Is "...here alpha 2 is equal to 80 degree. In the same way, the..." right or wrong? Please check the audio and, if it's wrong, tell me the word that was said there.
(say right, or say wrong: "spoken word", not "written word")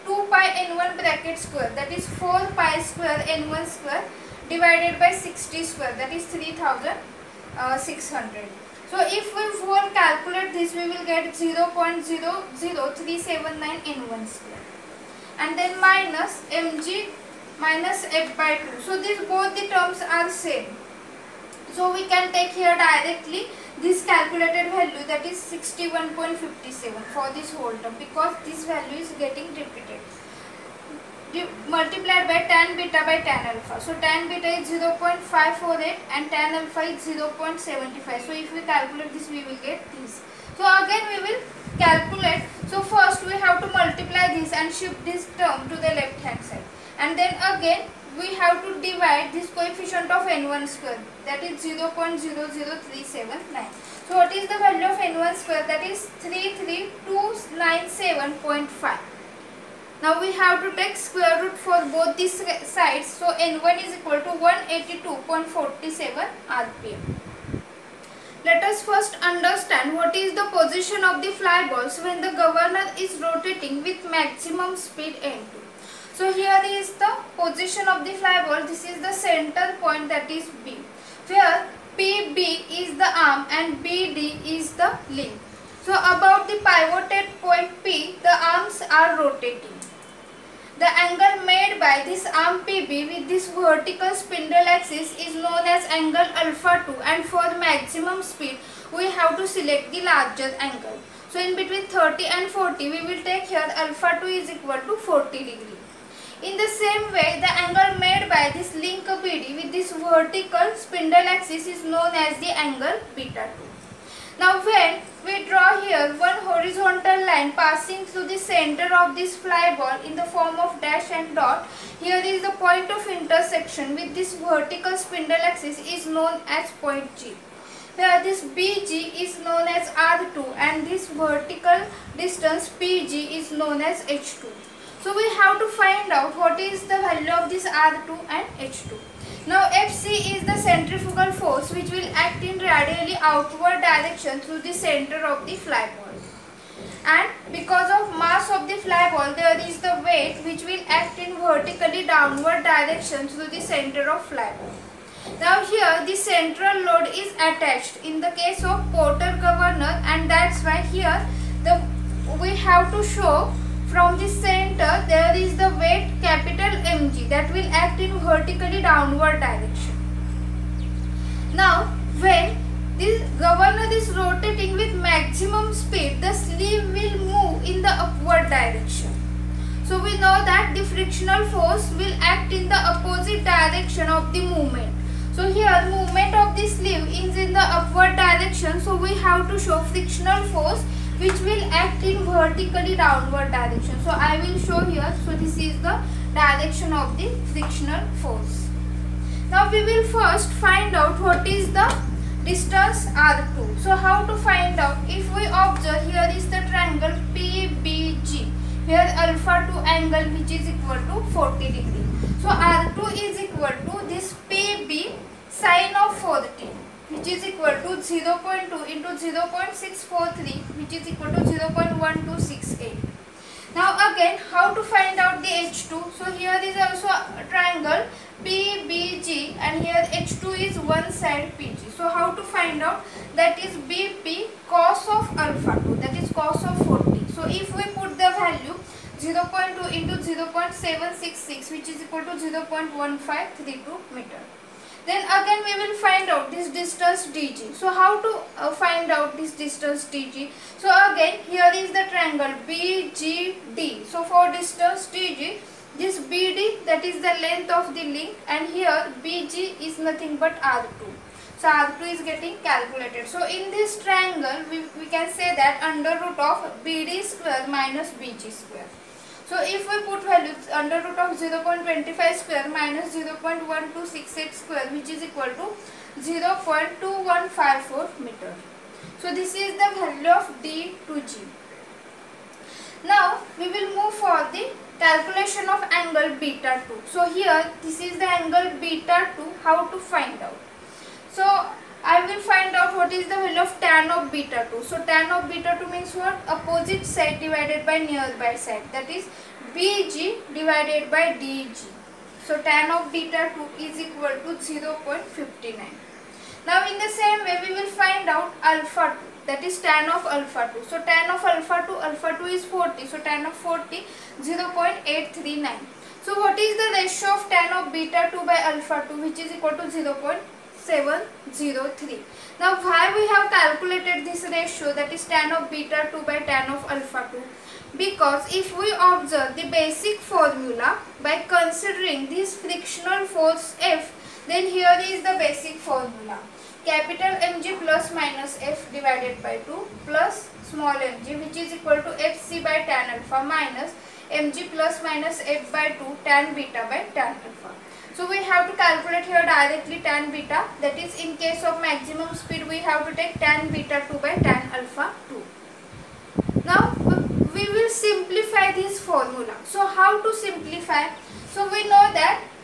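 wrong: "40", not "80".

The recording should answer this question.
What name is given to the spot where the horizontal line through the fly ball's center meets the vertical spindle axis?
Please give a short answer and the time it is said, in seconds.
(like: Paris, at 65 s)
point G, at 126 s.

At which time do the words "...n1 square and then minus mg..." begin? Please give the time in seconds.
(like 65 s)
13 s.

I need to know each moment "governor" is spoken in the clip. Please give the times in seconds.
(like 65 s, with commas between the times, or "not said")
72 s, 159 s, 173 s.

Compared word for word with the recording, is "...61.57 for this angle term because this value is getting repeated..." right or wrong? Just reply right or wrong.
wrong.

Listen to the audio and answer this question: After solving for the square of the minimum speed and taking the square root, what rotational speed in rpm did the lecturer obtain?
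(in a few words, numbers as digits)
182.47 rpm.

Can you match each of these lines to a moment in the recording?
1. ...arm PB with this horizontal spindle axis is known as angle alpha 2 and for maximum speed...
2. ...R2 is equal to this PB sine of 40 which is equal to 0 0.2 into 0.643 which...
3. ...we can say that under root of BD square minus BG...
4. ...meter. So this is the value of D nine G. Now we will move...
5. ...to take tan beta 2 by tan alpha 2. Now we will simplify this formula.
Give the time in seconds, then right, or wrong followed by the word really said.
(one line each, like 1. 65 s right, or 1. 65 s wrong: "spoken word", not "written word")
1. 92 s wrong: "vertical", not "horizontal"
2. 212 s right
3. 264 s right
4. 278 s wrong: "two", not "nine"
5. 353 s right.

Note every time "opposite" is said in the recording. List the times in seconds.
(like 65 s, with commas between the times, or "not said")
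182 s, 296 s.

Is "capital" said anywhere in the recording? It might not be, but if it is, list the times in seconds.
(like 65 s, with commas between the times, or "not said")
166 s, 336 s.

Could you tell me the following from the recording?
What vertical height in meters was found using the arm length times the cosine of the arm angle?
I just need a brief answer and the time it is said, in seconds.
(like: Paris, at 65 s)
0.1532 meters, at 242 s.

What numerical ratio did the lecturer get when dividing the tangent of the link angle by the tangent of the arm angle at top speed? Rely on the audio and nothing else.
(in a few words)
0.703.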